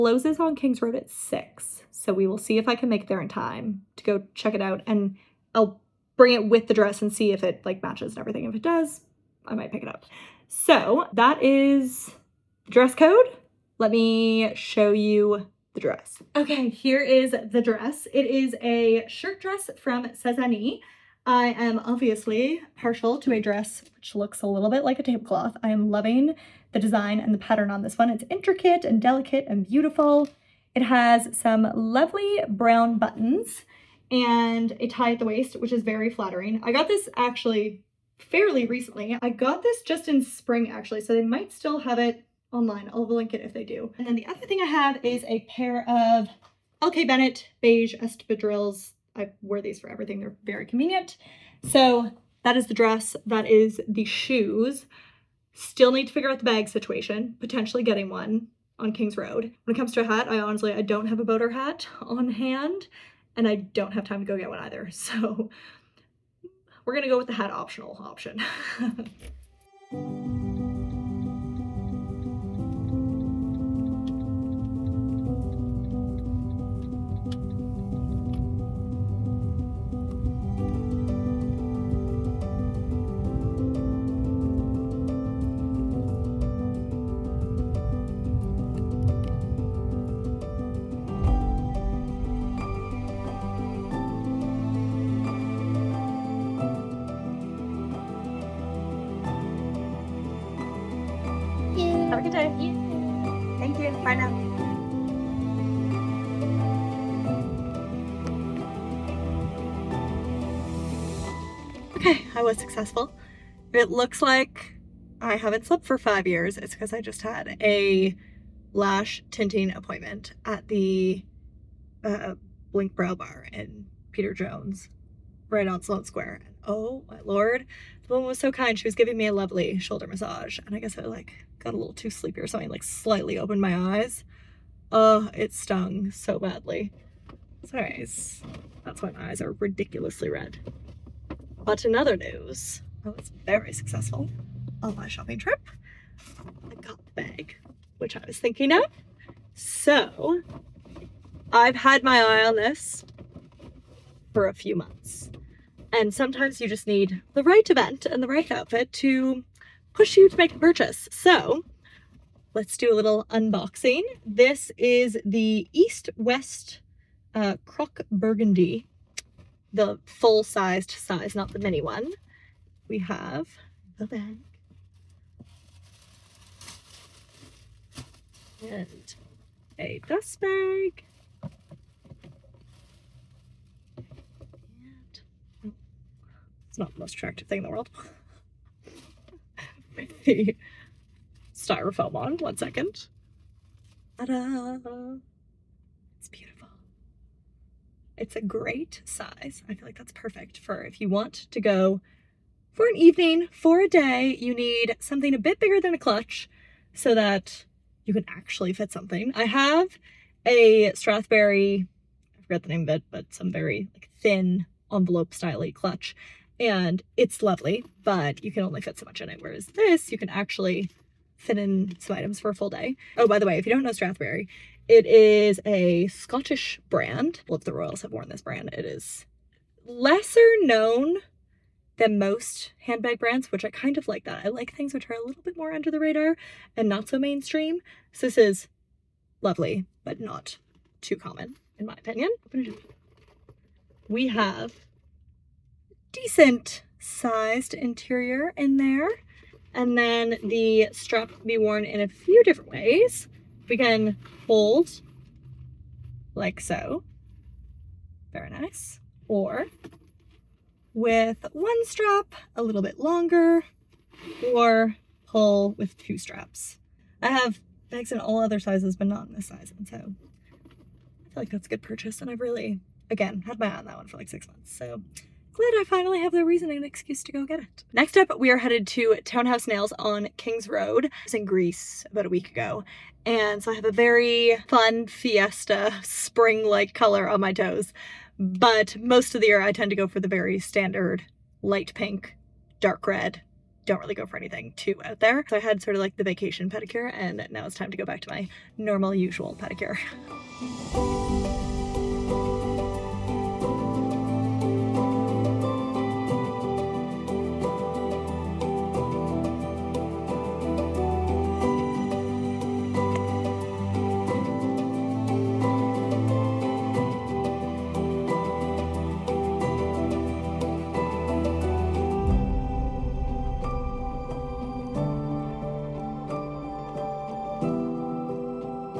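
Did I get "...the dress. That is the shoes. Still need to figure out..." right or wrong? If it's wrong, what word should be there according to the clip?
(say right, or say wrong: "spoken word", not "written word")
right.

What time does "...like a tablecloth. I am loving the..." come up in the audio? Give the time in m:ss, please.
0:24.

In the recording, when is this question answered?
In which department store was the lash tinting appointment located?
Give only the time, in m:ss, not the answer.
2:04.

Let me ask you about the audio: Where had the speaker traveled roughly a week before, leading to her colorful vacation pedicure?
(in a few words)
Greece.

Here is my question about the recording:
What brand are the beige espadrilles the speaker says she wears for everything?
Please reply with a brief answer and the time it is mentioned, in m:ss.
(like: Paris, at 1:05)
LK Bennett, at 0:46.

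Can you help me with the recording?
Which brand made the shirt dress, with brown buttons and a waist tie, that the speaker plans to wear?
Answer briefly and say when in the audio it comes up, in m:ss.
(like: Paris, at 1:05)
Sézane, at 0:20.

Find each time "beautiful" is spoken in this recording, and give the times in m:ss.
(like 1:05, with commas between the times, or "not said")
0:29, 3:16.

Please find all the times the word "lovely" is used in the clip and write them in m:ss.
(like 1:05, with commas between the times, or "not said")
0:31, 2:09, 3:37, 3:59.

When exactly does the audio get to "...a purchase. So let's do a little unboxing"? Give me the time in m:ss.
2:40.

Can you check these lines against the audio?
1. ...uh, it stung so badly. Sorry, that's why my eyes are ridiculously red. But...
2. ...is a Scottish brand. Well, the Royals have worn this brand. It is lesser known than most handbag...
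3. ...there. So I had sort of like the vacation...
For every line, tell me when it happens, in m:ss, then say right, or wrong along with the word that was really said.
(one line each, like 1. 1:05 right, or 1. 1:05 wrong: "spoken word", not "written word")
1. 2:15 right
2. 3:45 right
3. 4:55 right.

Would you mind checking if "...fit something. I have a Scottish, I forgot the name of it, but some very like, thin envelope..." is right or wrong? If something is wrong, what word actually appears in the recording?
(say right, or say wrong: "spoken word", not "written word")
wrong: "Strathberry", not "Scottish".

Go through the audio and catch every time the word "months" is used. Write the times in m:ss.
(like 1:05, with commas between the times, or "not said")
2:34, 4:34.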